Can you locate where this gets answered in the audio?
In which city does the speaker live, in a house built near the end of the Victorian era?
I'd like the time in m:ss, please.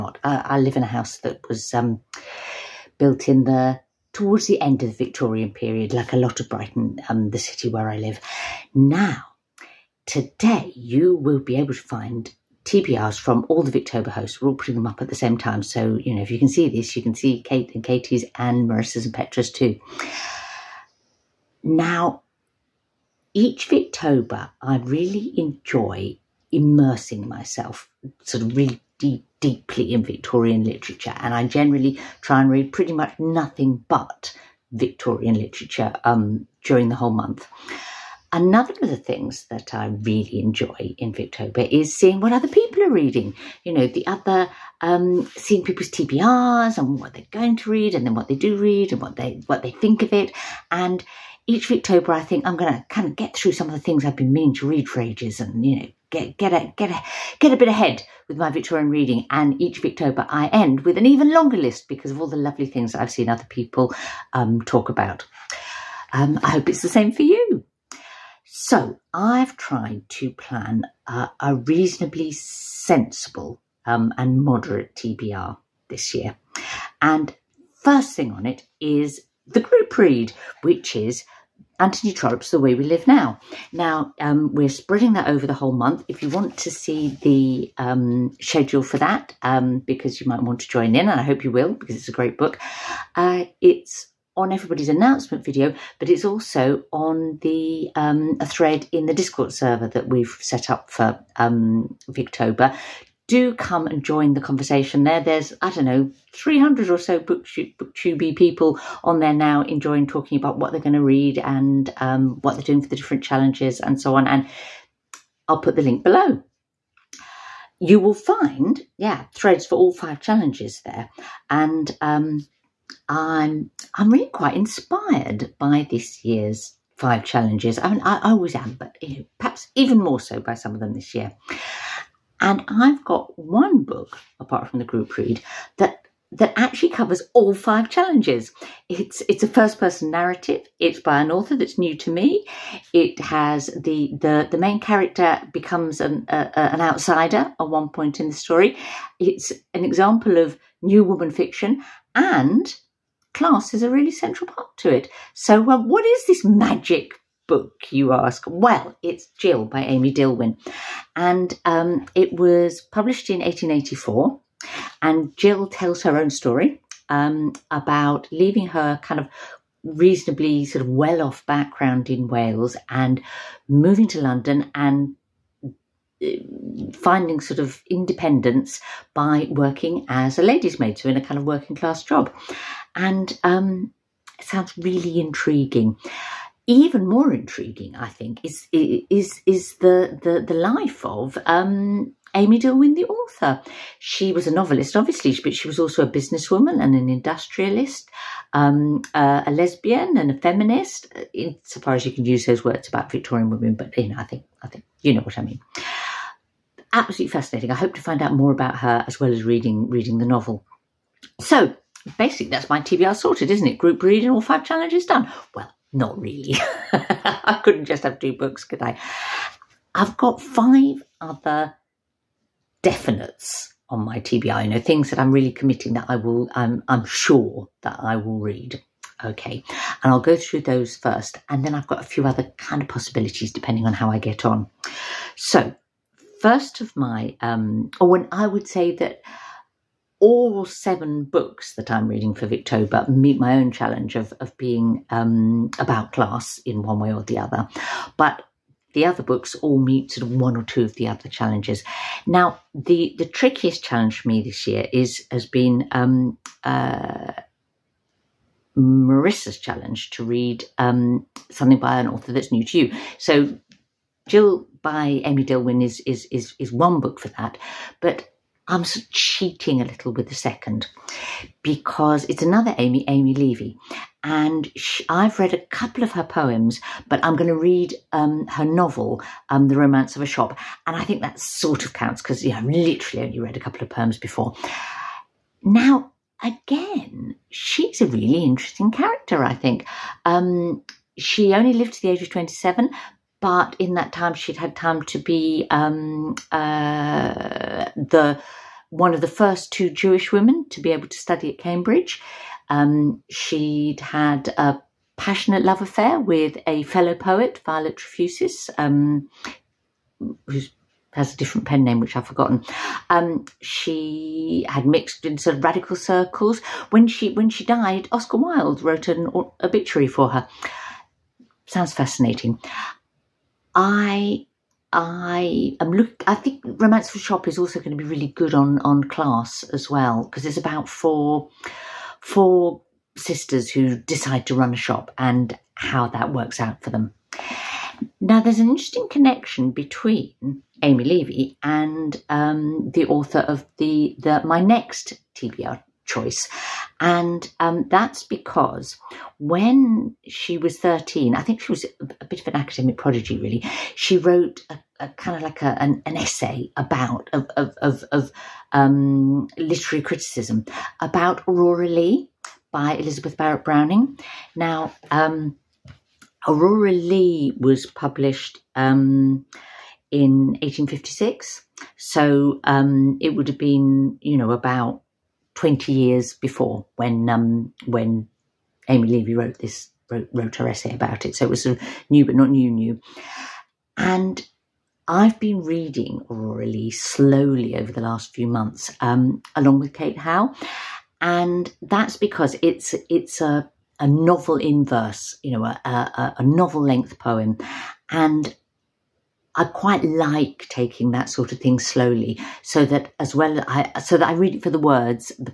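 0:06.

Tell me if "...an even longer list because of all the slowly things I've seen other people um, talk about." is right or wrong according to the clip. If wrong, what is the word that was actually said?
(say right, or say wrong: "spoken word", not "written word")
wrong: "lovely", not "slowly".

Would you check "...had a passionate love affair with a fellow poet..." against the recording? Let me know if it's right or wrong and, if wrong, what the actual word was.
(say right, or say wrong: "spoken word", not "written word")
right.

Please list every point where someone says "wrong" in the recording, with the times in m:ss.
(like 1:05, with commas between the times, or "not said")
not said.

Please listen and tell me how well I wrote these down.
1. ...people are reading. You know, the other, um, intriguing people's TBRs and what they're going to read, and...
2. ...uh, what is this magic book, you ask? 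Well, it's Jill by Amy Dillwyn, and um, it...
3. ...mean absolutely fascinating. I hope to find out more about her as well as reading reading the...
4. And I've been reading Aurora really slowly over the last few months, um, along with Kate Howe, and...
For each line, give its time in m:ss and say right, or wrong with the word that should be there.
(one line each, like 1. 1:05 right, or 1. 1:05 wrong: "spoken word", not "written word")
1. 0:42 wrong: "seeing", not "intriguing"
2. 2:35 right
3. 3:25 right
4. 6:23 right.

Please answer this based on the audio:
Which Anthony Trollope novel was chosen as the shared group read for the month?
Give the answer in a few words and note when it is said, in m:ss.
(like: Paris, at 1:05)
The Way We Live Now, at 1:22.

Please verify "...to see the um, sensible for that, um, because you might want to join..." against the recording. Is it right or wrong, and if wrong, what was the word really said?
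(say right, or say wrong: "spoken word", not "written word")
wrong: "schedule", not "sensible".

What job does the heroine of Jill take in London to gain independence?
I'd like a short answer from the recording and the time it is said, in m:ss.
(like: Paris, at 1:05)
ladies' maid, at 3:00.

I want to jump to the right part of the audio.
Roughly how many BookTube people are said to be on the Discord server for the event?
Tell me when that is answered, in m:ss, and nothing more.
1:46.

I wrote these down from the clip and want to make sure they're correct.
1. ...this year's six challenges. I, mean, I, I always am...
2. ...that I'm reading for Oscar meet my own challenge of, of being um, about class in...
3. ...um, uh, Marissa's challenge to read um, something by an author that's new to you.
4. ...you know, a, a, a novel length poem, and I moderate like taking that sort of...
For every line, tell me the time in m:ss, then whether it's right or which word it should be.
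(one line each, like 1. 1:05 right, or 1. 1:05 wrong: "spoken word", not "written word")
1. 2:05 wrong: "five", not "six"
2. 4:01 wrong: "Victober", not "Oscar"
3. 4:15 right
4. 6:35 wrong: "quite", not "moderate".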